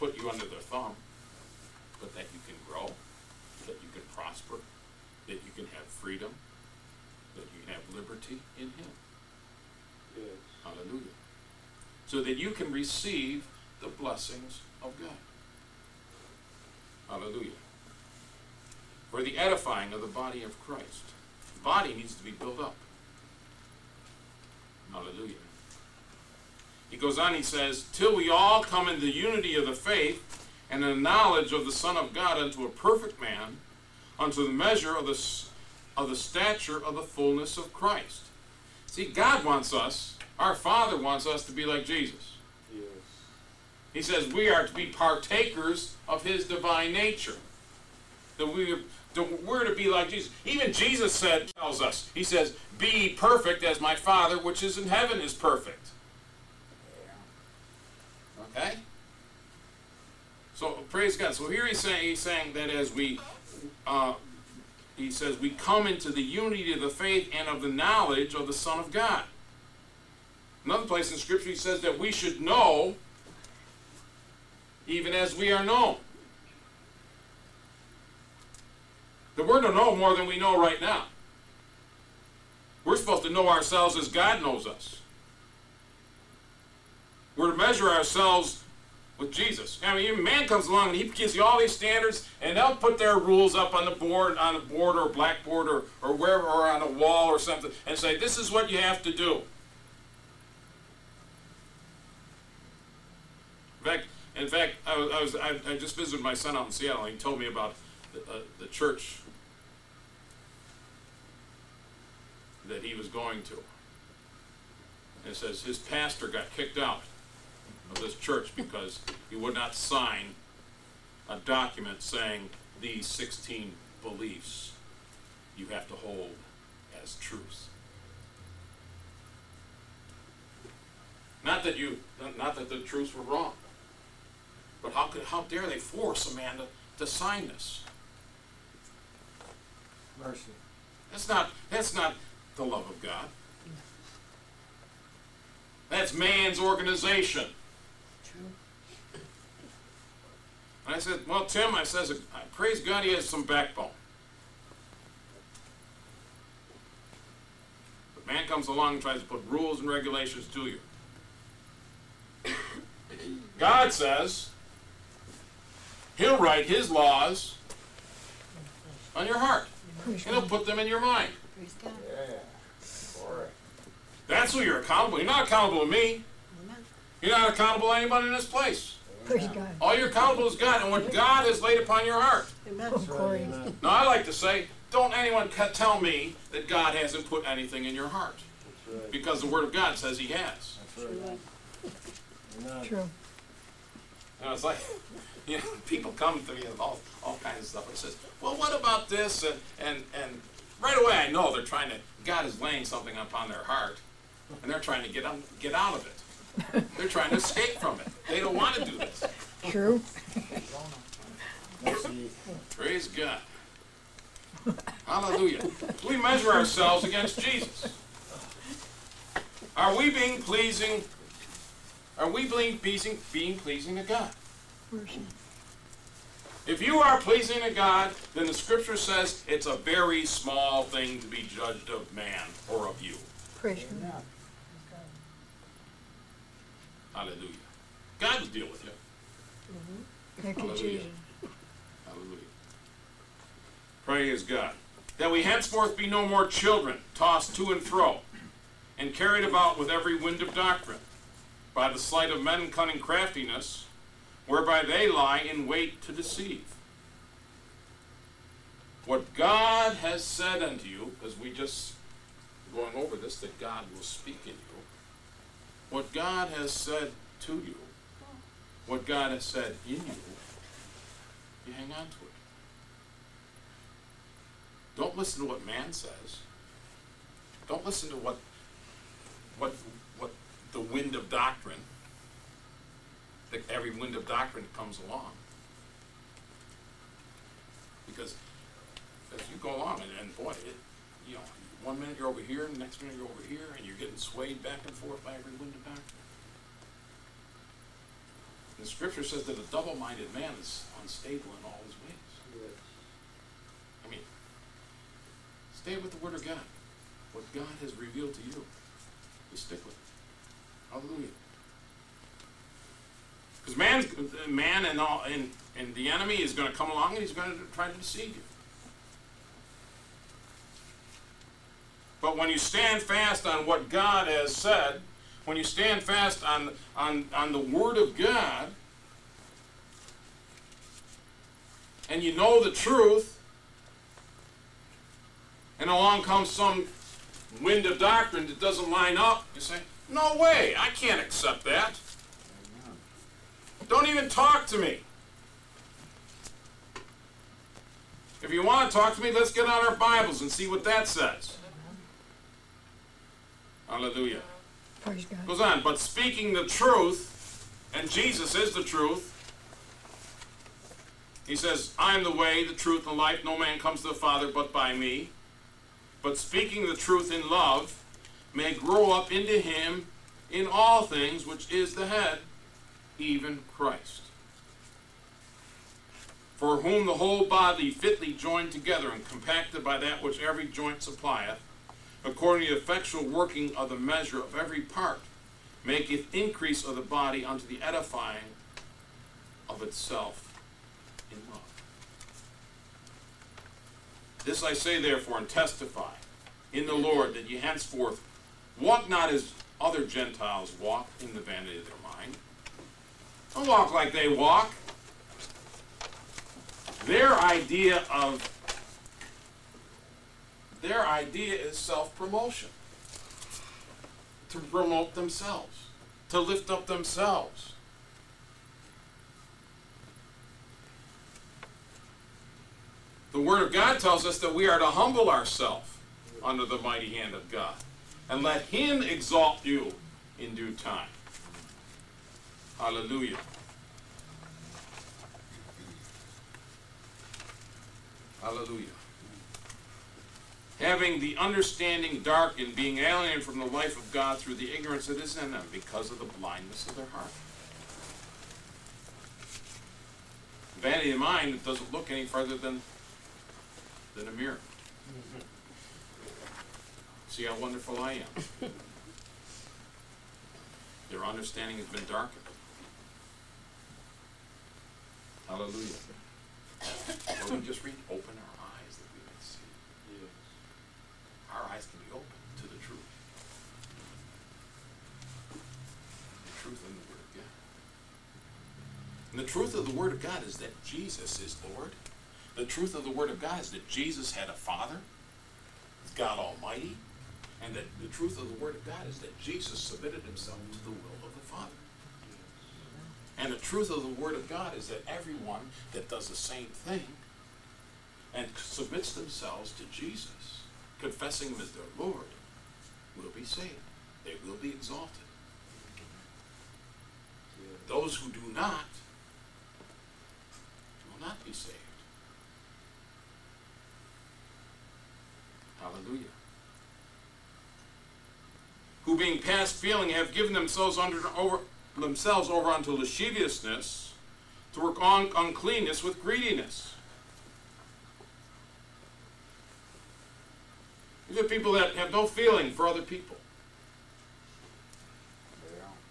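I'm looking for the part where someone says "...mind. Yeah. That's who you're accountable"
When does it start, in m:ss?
2:51.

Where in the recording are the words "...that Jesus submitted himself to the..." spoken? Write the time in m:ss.
8:09.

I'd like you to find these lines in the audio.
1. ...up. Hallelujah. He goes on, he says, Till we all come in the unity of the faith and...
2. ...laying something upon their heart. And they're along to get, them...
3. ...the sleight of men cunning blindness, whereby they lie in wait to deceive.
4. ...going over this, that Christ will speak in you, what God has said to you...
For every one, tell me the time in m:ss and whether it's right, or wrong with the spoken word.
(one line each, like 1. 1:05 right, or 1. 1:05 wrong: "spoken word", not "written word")
1. 0:22 right
2. 3:22 wrong: "trying", not "along"
3. 4:11 wrong: "craftiness", not "blindness"
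4. 4:22 wrong: "God", not "Christ".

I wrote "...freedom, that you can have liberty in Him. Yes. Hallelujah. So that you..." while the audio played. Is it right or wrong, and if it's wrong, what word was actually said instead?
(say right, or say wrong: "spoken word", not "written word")
right.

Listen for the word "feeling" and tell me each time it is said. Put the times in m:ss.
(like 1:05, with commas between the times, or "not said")
8:39, 8:52.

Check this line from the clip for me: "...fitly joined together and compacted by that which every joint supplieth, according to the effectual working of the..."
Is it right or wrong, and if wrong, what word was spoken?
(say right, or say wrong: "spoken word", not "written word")
right.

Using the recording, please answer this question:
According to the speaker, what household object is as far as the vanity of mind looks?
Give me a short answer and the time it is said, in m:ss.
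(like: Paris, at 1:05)
a mirror, at 7:34.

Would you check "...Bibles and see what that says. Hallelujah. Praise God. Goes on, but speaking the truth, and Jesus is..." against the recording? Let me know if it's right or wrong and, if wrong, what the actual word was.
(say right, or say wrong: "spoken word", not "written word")
right.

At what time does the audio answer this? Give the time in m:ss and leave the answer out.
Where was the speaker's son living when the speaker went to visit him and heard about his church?
1:46.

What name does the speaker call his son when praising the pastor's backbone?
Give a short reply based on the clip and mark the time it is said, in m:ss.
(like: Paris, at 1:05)
Tim, at 2:31.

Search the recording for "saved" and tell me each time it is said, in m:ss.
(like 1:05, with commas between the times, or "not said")
8:23, 8:31.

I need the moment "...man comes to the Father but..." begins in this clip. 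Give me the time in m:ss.
6:03.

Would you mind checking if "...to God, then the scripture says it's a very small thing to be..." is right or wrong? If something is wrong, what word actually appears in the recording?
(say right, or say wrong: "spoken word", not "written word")
right.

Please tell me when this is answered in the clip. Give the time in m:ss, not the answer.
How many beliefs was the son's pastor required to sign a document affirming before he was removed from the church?
2:03.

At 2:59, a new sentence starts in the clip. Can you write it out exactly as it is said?
All you're accountable is God and what God has laid upon your heart.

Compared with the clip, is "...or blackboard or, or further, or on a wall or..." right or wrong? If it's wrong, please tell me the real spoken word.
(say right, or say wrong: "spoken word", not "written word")
wrong: "wherever", not "further".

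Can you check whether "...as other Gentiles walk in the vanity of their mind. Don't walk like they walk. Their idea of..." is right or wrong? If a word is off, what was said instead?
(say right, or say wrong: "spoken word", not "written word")
right.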